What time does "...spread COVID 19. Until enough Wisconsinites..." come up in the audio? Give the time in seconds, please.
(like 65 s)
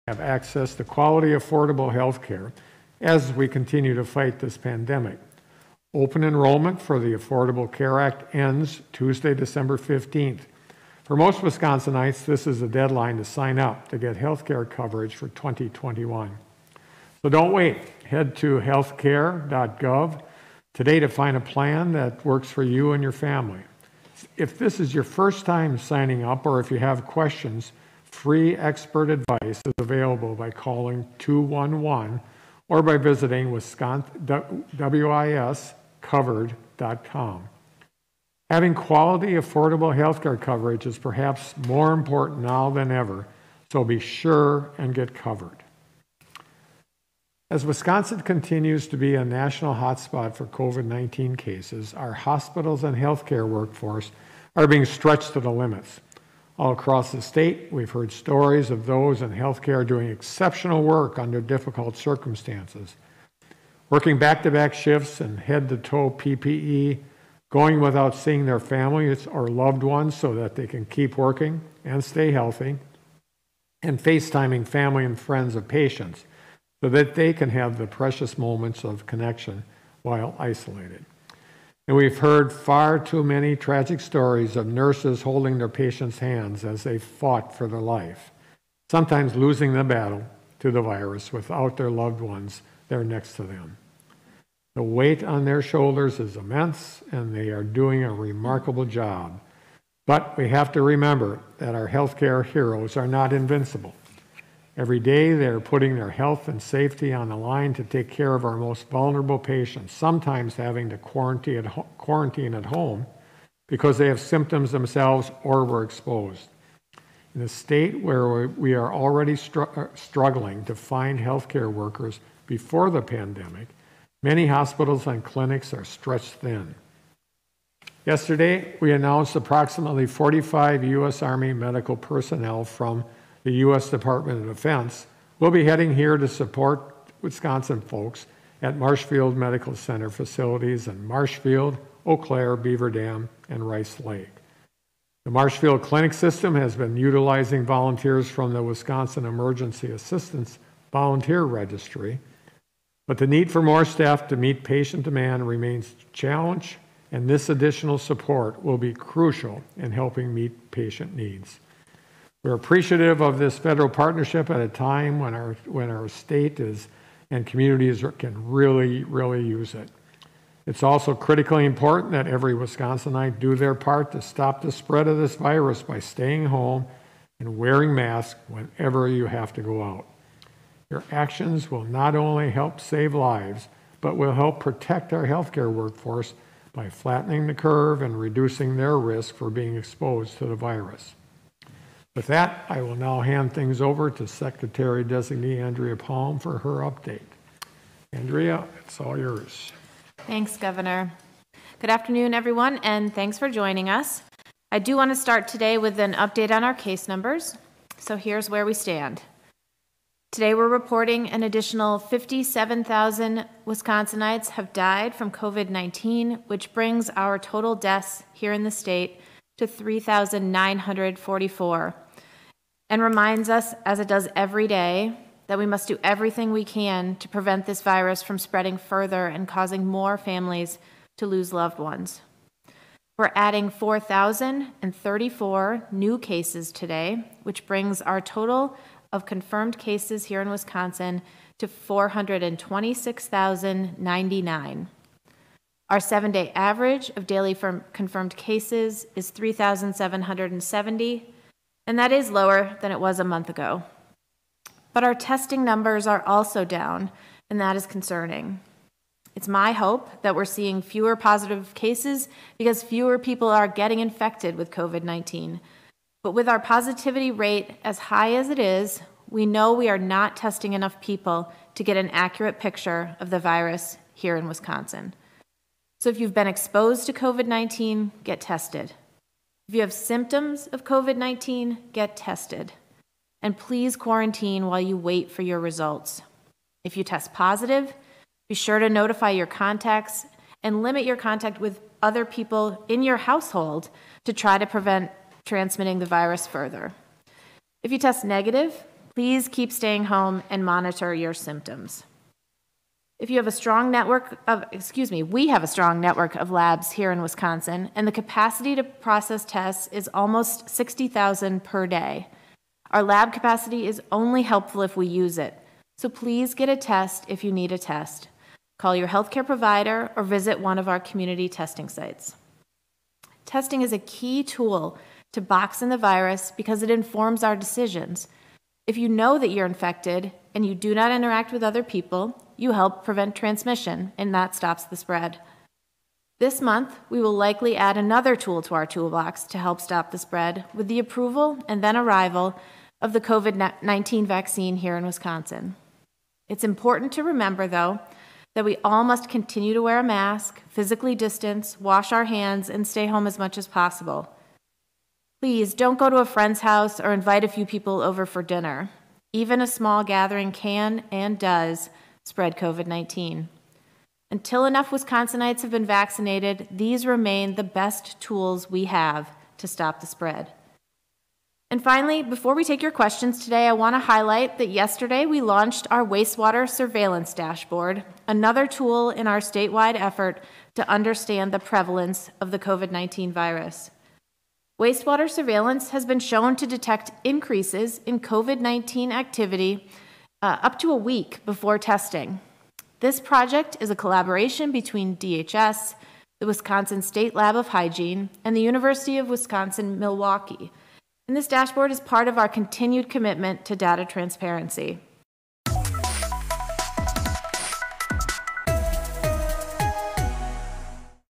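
362 s.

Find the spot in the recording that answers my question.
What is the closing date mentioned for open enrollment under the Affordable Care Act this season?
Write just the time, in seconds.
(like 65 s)
9 s.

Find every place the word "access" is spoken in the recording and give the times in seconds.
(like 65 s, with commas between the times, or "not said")
0 s.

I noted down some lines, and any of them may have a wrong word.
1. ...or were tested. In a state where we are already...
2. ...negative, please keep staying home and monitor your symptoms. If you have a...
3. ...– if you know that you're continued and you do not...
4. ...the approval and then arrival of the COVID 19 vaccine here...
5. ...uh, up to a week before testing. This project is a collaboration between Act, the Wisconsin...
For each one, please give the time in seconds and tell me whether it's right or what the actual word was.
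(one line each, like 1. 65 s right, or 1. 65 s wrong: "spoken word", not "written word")
1. 115 s wrong: "exposed", not "tested"
2. 298 s right
3. 328 s wrong: "infected", not "continued"
4. 340 s right
5. 390 s wrong: "DHS", not "Act".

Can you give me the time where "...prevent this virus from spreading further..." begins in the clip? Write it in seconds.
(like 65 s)
227 s.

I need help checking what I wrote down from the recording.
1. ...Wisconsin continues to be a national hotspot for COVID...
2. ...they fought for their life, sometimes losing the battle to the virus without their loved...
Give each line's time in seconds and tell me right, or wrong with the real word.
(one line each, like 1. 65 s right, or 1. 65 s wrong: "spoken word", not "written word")
1. 47 s right
2. 86 s right.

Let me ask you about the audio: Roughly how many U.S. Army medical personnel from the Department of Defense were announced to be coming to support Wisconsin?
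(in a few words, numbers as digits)
45.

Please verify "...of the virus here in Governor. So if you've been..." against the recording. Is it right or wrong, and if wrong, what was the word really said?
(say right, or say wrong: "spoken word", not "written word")
wrong: "Wisconsin", not "Governor".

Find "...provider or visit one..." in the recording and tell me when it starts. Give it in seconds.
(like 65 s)
319 s.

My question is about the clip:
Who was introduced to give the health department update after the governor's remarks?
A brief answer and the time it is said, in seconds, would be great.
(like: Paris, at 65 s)
Andrea Palm, at 195 s.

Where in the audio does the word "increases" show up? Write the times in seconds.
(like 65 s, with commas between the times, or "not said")
387 s.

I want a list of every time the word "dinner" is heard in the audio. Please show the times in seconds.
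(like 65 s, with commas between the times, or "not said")
358 s.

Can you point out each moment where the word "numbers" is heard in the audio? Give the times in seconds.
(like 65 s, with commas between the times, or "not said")
207 s, 255 s.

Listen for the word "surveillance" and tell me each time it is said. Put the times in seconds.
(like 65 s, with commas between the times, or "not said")
376 s, 385 s.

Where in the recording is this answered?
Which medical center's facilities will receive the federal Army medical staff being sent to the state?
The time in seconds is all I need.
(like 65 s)
138 s.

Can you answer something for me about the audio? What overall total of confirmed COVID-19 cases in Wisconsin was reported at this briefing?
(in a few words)
426,099.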